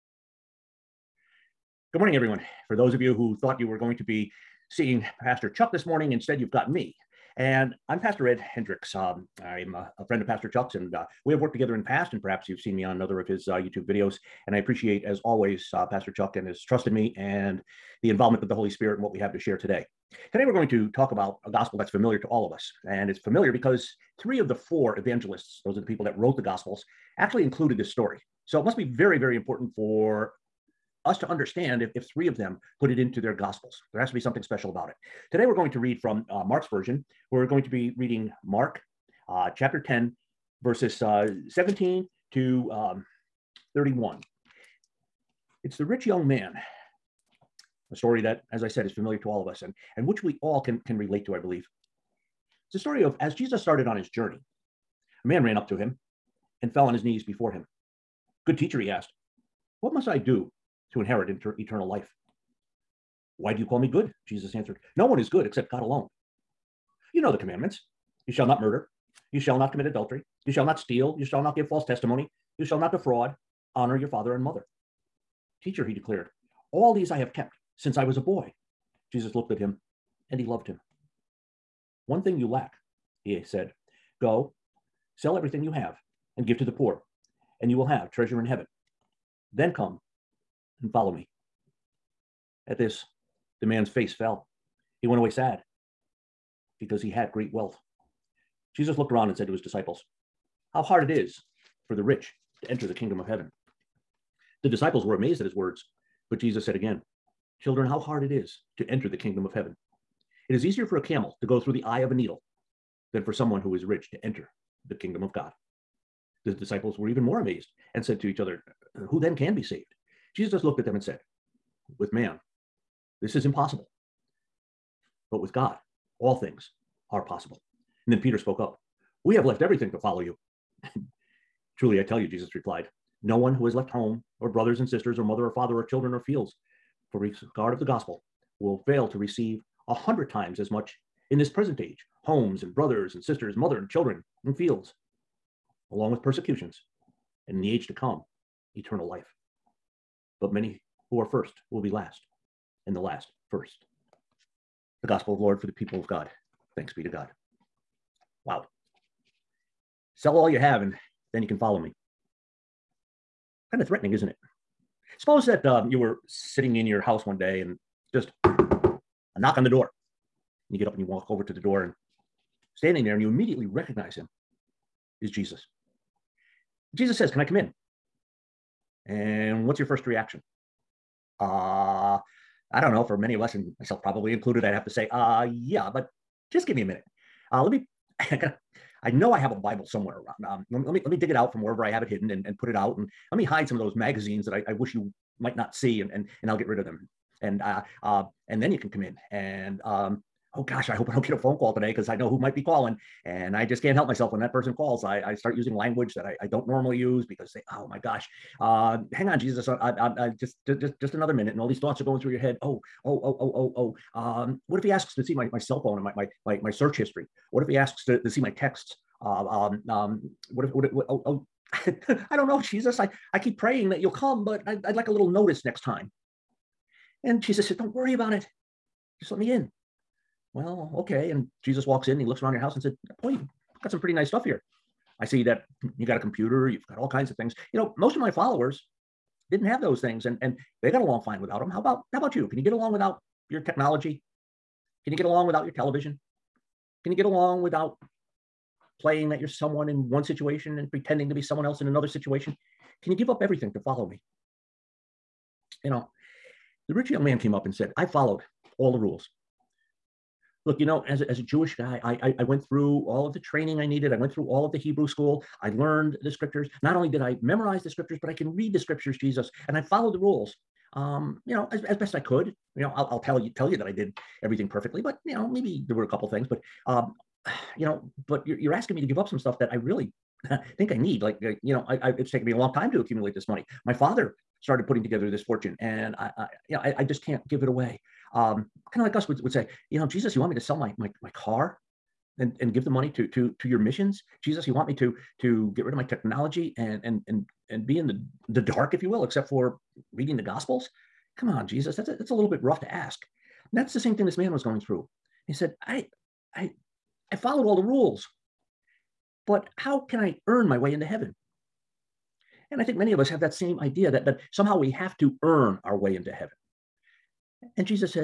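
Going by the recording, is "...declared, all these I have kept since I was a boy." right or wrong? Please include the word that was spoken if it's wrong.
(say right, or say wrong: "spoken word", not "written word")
right.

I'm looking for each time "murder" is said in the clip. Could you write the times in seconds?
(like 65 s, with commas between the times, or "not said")
68 s.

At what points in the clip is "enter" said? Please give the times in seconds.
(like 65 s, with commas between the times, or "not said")
102 s, 108 s, 114 s.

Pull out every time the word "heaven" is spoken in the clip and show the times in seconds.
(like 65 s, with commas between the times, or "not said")
88 s, 103 s, 109 s, 311 s, 316 s.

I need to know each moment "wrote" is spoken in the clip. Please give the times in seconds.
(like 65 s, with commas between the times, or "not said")
26 s.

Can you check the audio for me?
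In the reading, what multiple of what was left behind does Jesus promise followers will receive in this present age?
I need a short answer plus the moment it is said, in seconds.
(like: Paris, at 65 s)
A hundred times, at 139 s.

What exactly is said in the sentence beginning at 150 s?
But many who are first will be last, and the last first.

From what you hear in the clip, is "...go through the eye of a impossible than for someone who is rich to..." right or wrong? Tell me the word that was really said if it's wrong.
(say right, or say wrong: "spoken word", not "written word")
wrong: "needle", not "impossible".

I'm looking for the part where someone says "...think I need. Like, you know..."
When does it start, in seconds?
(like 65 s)
280 s.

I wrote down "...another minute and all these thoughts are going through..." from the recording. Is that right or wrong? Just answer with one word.
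right.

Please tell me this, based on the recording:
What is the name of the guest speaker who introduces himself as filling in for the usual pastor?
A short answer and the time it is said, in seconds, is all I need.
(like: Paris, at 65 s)
Ed Hendricks, at 8 s.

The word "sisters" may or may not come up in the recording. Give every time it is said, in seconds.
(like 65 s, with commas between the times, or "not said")
134 s, 143 s.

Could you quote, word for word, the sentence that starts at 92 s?
At this, the man's face fell.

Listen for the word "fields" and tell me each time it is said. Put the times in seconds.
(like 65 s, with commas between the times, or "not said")
136 s, 144 s.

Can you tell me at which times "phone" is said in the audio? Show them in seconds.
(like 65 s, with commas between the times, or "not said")
201 s, 215 s.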